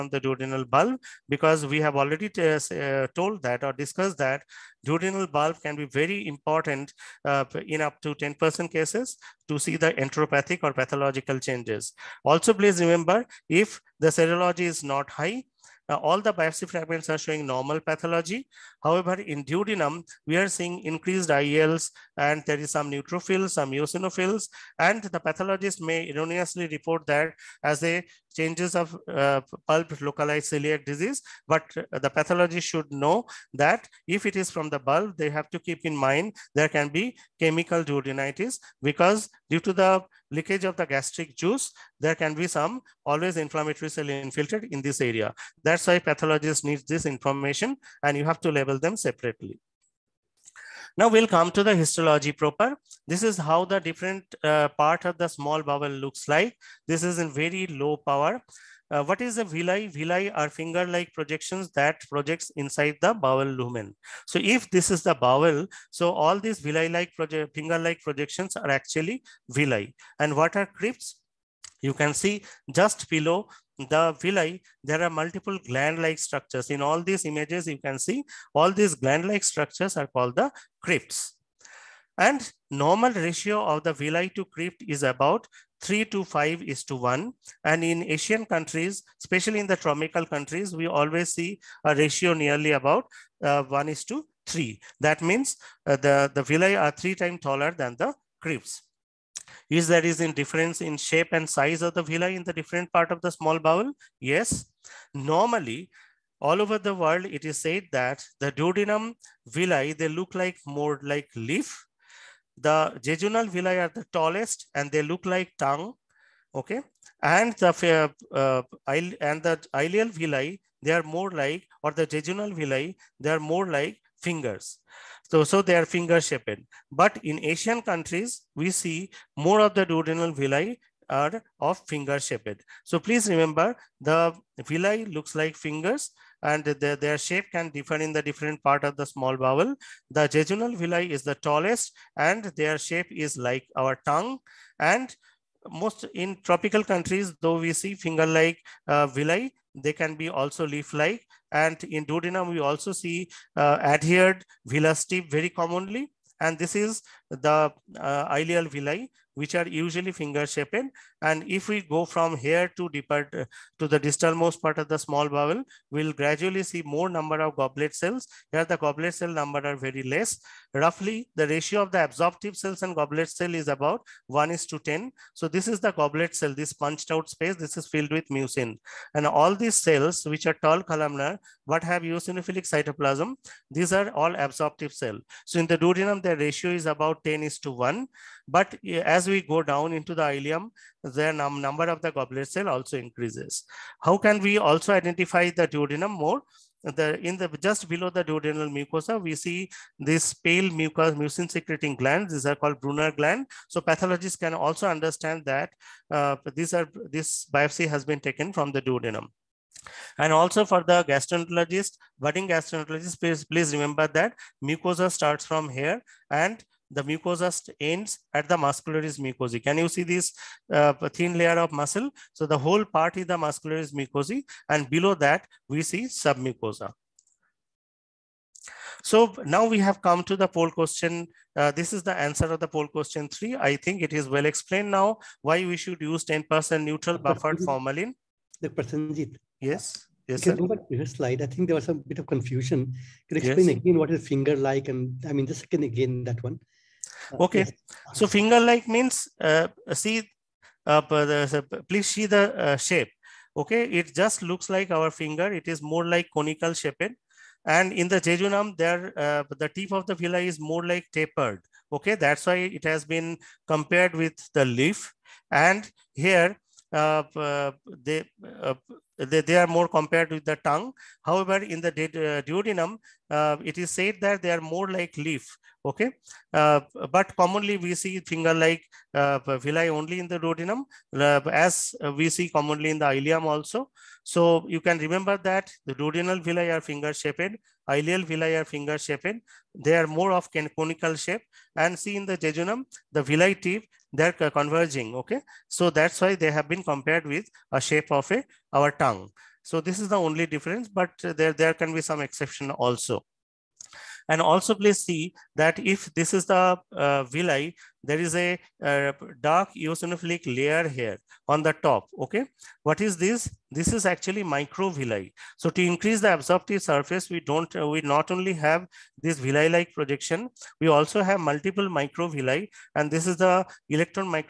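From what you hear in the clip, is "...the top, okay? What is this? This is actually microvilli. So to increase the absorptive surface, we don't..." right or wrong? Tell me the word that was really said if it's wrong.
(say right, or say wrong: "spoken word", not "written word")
right.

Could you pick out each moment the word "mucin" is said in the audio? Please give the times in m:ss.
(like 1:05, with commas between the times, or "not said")
2:58, 3:21.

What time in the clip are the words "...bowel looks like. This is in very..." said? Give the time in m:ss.
0:55.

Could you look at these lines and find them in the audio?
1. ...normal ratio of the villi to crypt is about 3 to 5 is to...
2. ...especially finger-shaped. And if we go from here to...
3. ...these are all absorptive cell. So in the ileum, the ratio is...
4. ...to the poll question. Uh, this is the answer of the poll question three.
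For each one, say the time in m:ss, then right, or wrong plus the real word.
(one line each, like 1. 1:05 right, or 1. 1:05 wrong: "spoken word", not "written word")
1. 1:22 right
2. 2:39 wrong: "usually", not "especially"
3. 3:03 wrong: "duodenum", not "ileum"
4. 3:50 right.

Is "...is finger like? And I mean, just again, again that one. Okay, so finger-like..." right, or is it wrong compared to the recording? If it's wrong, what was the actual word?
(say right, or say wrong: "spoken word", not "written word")
right.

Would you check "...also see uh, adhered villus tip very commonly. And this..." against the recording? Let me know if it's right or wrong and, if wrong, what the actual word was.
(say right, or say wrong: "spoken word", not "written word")
right.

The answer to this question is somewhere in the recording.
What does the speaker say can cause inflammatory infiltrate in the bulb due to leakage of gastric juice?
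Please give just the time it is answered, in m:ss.
0:37.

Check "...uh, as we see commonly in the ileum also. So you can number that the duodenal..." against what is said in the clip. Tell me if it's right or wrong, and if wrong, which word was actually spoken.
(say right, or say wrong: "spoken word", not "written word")
wrong: "remember", not "number".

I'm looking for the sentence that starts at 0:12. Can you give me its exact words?
Also, please remember, if the serology is not high, uh, all the biopsy fragments are showing normal pathology.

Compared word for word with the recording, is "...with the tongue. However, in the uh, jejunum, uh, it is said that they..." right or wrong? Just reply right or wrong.
wrong.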